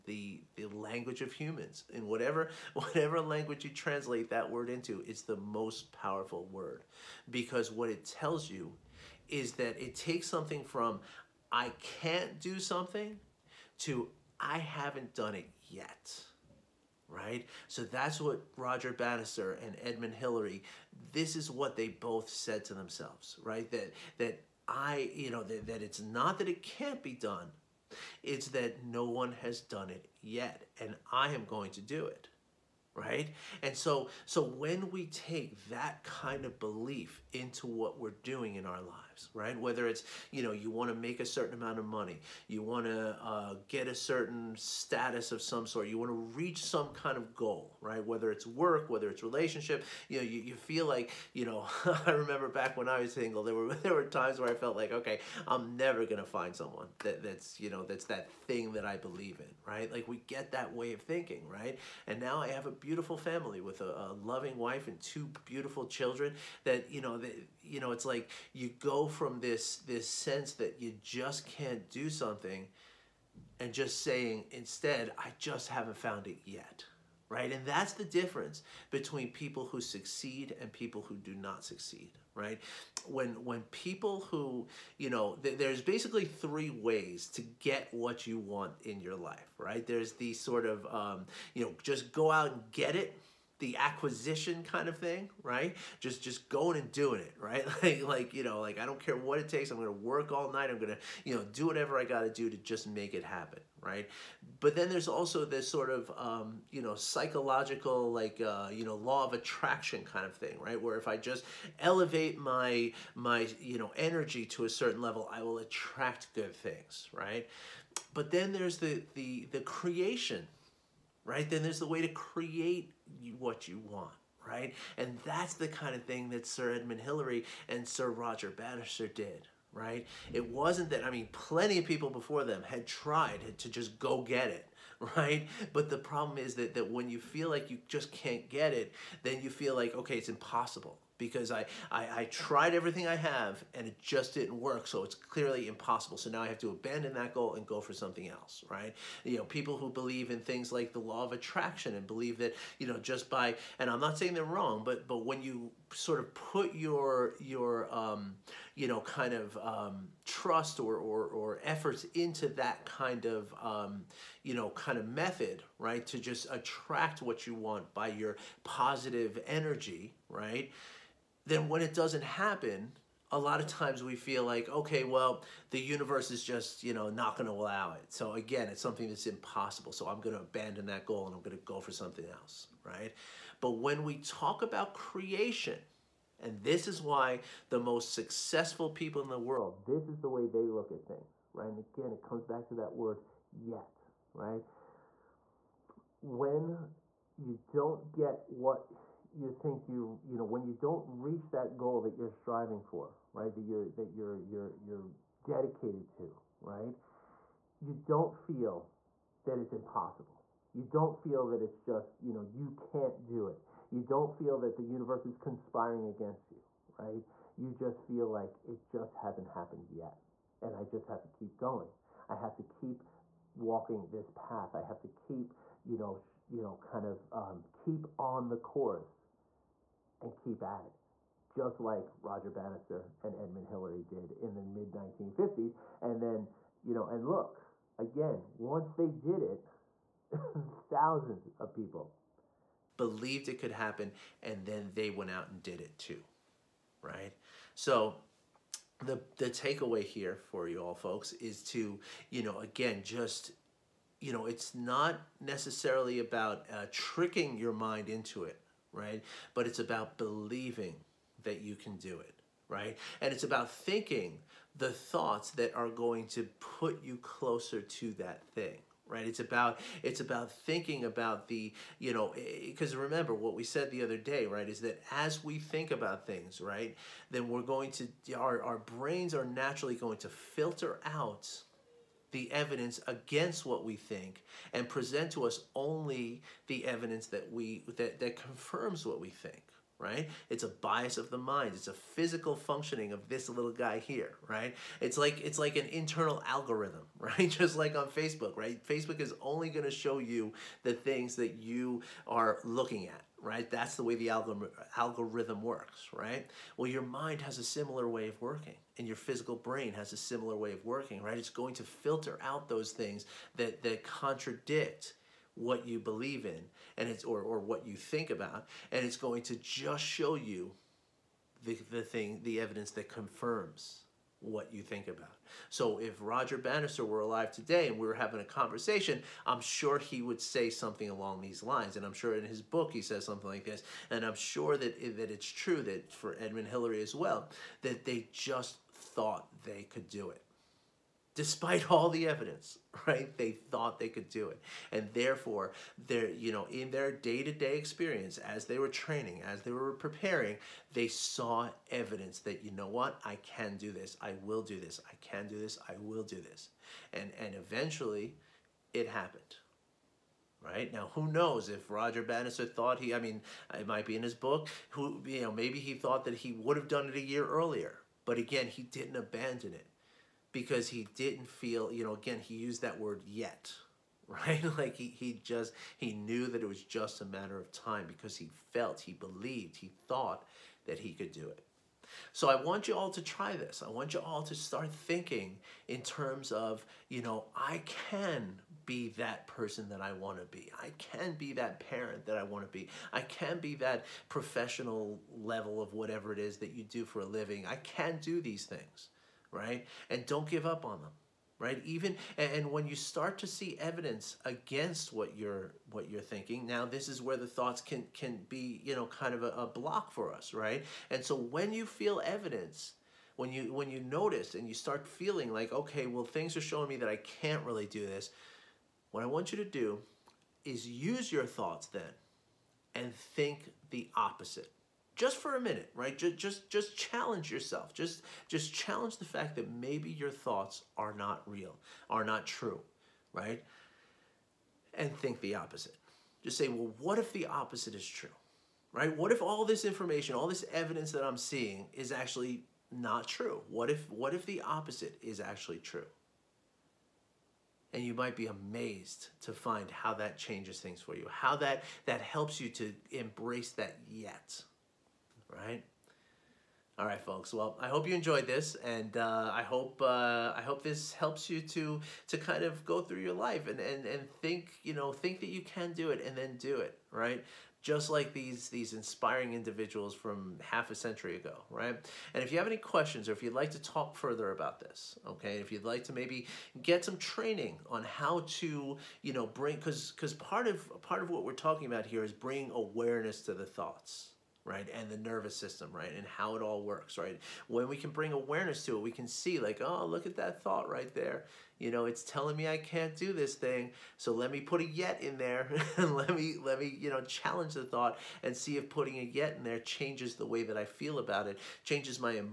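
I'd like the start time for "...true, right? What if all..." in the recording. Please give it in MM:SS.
07:18.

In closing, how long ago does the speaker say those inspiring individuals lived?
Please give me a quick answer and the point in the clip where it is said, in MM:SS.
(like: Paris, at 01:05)
half a century, at 07:50.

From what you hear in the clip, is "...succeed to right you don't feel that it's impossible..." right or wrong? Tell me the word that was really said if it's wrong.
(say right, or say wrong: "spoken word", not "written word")
wrong: "dedicated", not "succeed".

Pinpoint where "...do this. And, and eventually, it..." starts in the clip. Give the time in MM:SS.
05:56.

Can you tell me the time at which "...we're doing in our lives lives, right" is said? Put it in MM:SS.
00:38.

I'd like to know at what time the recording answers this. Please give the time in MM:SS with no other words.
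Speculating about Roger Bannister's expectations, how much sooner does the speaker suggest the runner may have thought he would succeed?
06:07.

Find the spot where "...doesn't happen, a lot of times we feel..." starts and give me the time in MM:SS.
02:51.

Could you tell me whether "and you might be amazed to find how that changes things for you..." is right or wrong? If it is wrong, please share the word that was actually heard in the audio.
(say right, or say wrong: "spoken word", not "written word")
right.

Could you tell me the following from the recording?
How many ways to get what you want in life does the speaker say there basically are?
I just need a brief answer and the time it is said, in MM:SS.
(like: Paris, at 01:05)
3, at 01:26.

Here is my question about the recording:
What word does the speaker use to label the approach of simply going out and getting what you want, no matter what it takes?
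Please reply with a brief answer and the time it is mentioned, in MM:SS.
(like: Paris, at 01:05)
acquisition, at 01:33.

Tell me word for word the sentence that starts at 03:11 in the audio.
And again, it comes back to that word yet, right?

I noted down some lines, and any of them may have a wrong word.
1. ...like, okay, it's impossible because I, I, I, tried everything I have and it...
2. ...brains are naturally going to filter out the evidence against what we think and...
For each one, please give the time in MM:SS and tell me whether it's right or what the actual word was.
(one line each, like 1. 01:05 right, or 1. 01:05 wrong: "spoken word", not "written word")
1. 02:19 right
2. 04:38 right.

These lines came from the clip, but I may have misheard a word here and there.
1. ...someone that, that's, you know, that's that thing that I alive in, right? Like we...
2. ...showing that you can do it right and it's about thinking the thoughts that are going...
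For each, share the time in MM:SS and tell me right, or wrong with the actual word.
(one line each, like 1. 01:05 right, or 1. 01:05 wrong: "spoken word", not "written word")
1. 00:56 wrong: "believe", not "alive"
2. 04:20 wrong: "believing", not "showing".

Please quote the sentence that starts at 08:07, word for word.
When we can bring awareness to it, we can see, like, oh, look at that thought right there.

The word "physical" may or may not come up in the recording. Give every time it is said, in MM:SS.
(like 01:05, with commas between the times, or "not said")
04:51, 05:09.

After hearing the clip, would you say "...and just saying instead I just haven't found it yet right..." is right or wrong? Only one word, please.
right.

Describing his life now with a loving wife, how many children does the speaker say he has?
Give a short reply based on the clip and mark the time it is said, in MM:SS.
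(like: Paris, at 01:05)
2, at 01:05.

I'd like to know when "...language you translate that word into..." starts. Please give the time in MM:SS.
00:03.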